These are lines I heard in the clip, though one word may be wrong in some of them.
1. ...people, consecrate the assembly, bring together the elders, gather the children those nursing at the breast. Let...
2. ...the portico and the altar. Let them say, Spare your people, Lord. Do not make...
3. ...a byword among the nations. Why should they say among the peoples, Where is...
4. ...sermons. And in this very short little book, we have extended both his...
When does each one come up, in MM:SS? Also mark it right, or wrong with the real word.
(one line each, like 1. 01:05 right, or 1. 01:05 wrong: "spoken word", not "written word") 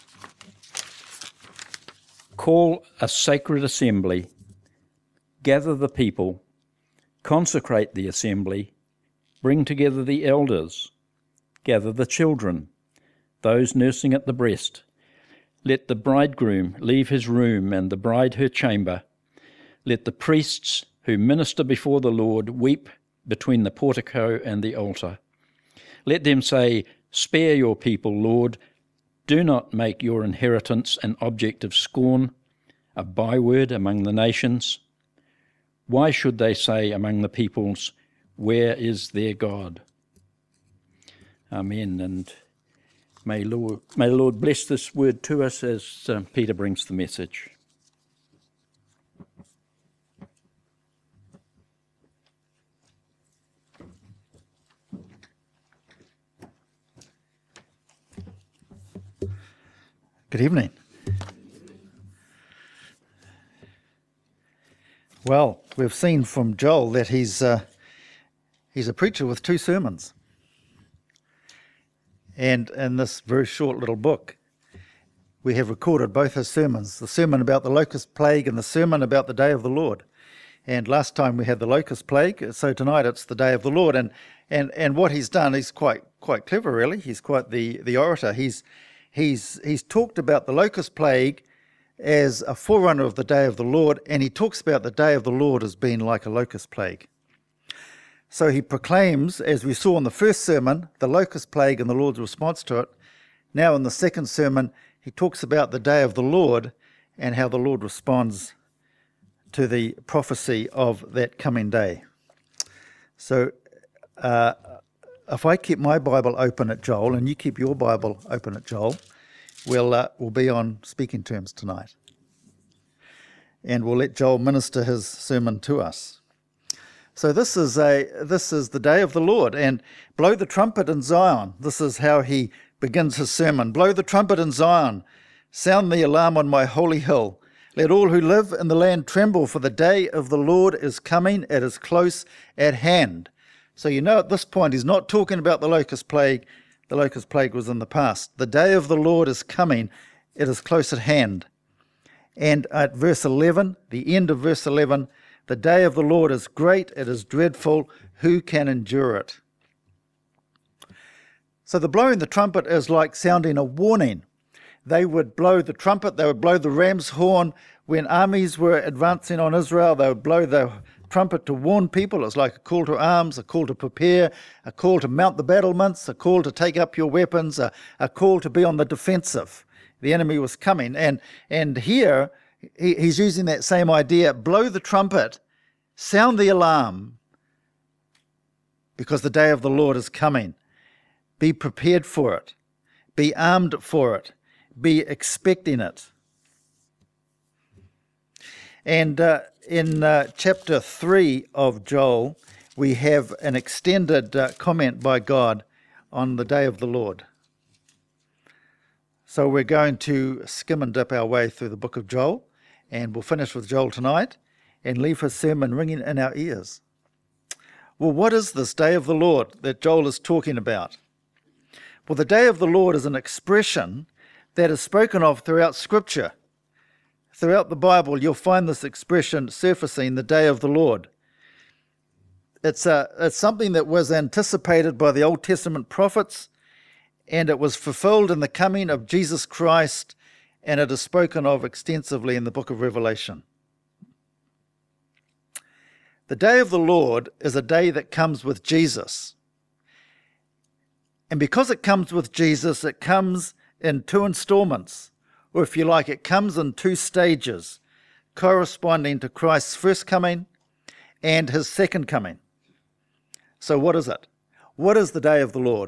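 1. 00:05 right
2. 00:23 right
3. 00:32 right
4. 01:09 wrong: "recorded", not "extended".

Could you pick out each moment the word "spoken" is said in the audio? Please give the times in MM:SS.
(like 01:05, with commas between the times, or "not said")
03:44, 04:00.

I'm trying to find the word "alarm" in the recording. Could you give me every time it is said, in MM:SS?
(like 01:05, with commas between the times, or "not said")
02:16, 03:06.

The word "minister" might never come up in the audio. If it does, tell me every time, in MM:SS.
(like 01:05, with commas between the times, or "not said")
00:21, 02:04.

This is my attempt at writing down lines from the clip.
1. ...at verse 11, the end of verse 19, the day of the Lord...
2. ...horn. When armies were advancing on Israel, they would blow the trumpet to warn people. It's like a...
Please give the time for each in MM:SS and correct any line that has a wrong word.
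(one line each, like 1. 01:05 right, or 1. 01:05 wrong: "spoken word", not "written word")
1. 02:32 wrong: "11", not "19"
2. 02:47 right.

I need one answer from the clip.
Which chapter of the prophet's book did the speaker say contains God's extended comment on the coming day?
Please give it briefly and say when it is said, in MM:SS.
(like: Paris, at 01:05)
Chapter 3, at 03:20.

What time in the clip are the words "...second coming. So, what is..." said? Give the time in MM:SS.
04:21.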